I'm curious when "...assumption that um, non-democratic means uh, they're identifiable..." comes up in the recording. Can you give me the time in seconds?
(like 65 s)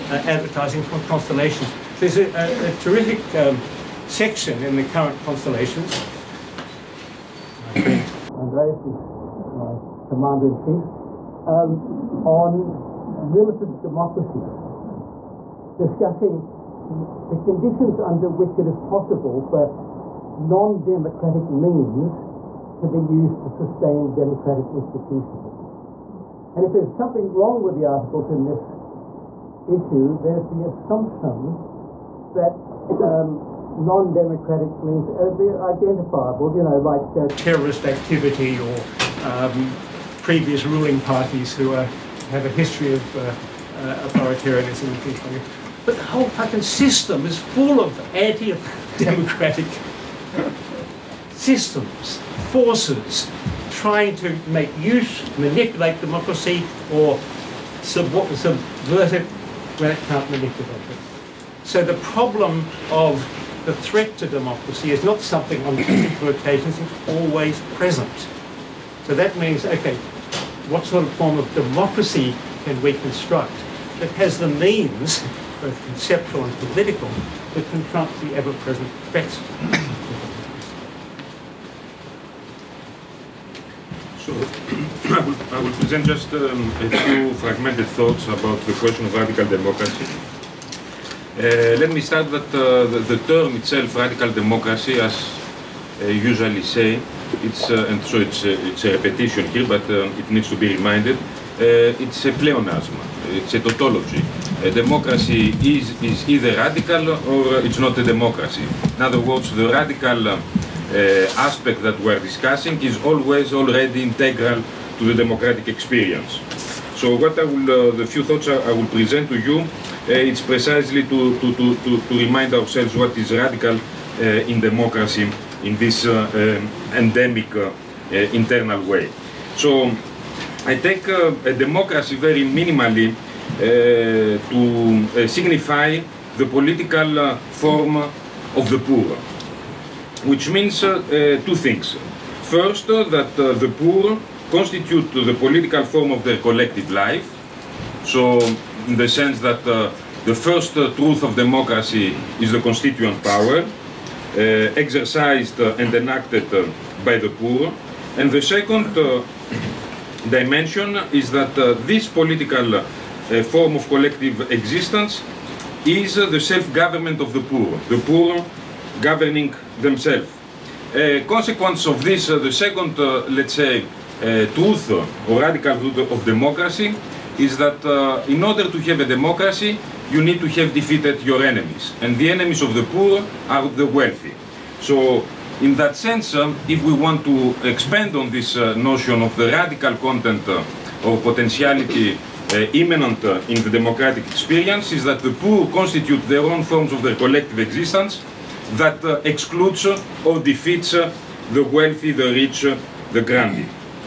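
30 s.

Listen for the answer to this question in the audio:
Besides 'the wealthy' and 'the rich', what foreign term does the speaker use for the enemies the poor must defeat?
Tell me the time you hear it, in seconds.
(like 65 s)
203 s.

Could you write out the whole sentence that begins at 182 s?
And the enemies of the poor are the wealthy.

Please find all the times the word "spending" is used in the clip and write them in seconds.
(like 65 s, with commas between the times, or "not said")
not said.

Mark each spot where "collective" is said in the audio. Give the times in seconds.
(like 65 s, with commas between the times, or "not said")
146 s, 163 s, 197 s.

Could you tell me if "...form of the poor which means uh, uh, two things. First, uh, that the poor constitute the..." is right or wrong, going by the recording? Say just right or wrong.
right.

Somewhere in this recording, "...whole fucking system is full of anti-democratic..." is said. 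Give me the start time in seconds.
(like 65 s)
46 s.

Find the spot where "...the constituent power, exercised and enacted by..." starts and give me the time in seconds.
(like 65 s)
152 s.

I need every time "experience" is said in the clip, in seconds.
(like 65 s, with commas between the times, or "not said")
115 s, 194 s.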